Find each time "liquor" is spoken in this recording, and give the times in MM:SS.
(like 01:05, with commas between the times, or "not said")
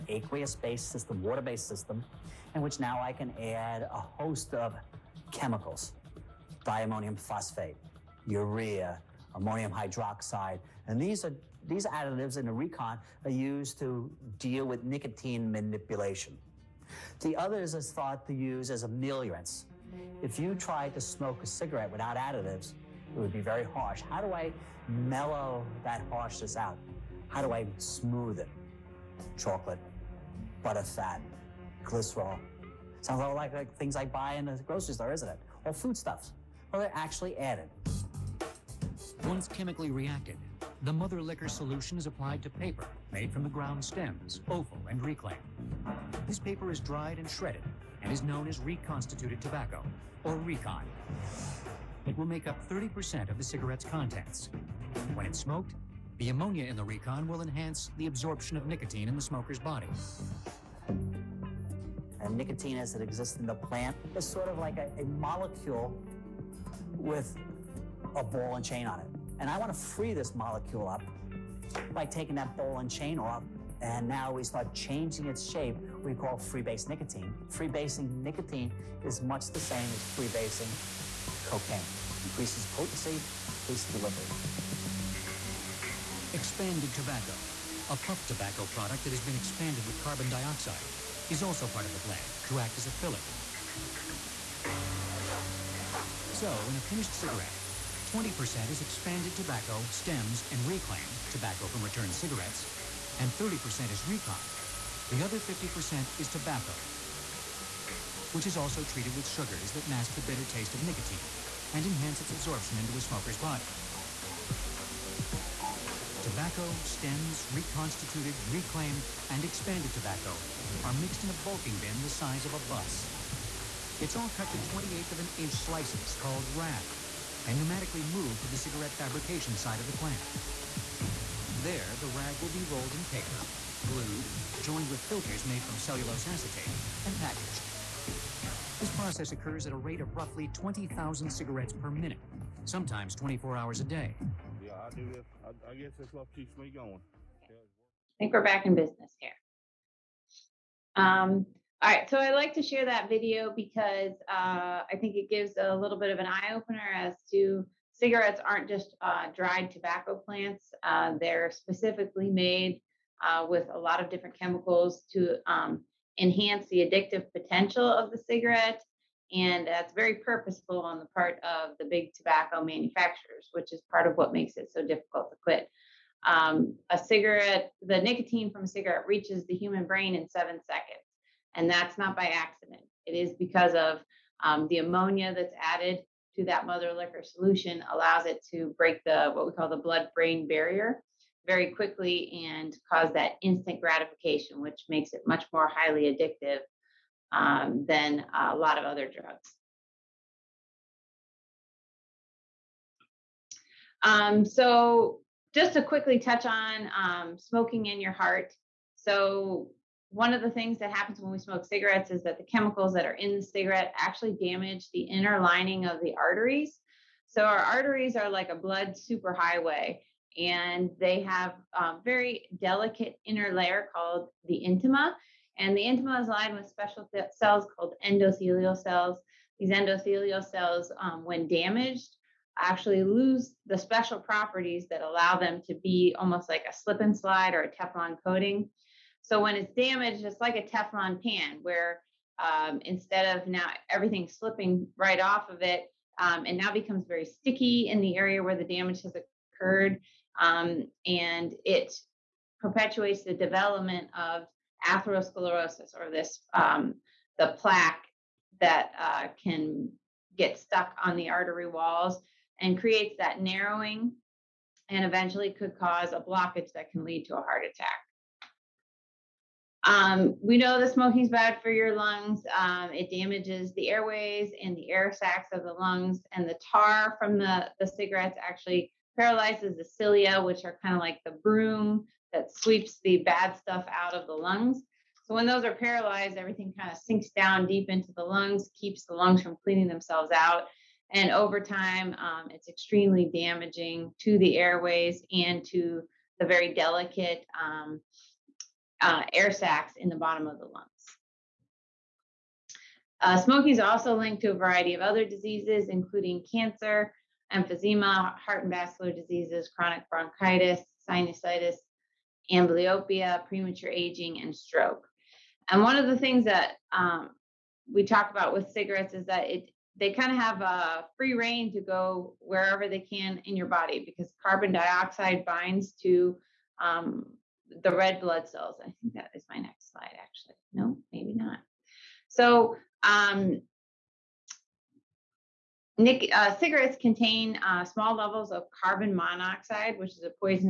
00:41, 03:06.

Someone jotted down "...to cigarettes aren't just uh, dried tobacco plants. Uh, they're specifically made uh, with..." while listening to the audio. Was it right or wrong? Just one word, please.
right.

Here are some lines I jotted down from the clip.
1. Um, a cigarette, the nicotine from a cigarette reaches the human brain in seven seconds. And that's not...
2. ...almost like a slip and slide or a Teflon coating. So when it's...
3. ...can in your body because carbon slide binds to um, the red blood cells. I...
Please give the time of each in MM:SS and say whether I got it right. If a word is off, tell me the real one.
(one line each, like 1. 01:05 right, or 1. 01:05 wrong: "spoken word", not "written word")
1. 02:56 right
2. 03:56 right
3. 05:22 wrong: "dioxide", not "slide".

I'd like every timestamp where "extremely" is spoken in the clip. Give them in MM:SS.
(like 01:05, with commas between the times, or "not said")
04:52.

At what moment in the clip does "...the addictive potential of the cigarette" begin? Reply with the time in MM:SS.
02:46.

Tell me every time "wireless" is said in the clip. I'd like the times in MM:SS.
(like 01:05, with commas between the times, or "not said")
not said.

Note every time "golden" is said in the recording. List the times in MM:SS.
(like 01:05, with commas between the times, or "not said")
not said.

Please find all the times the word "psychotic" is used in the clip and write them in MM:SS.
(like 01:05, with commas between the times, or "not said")
not said.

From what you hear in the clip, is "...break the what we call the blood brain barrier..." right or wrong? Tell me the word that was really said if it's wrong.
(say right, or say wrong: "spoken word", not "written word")
right.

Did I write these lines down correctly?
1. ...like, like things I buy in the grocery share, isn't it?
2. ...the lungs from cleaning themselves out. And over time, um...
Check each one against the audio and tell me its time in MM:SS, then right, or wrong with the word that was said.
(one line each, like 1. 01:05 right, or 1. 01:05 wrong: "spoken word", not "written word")
1. 00:33 wrong: "store", not "share"
2. 04:49 right.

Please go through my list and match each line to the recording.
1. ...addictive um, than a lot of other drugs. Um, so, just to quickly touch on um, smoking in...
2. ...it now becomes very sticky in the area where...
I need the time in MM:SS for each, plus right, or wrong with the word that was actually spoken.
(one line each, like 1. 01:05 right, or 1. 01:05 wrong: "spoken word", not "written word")
1. 03:16 right
2. 04:06 right.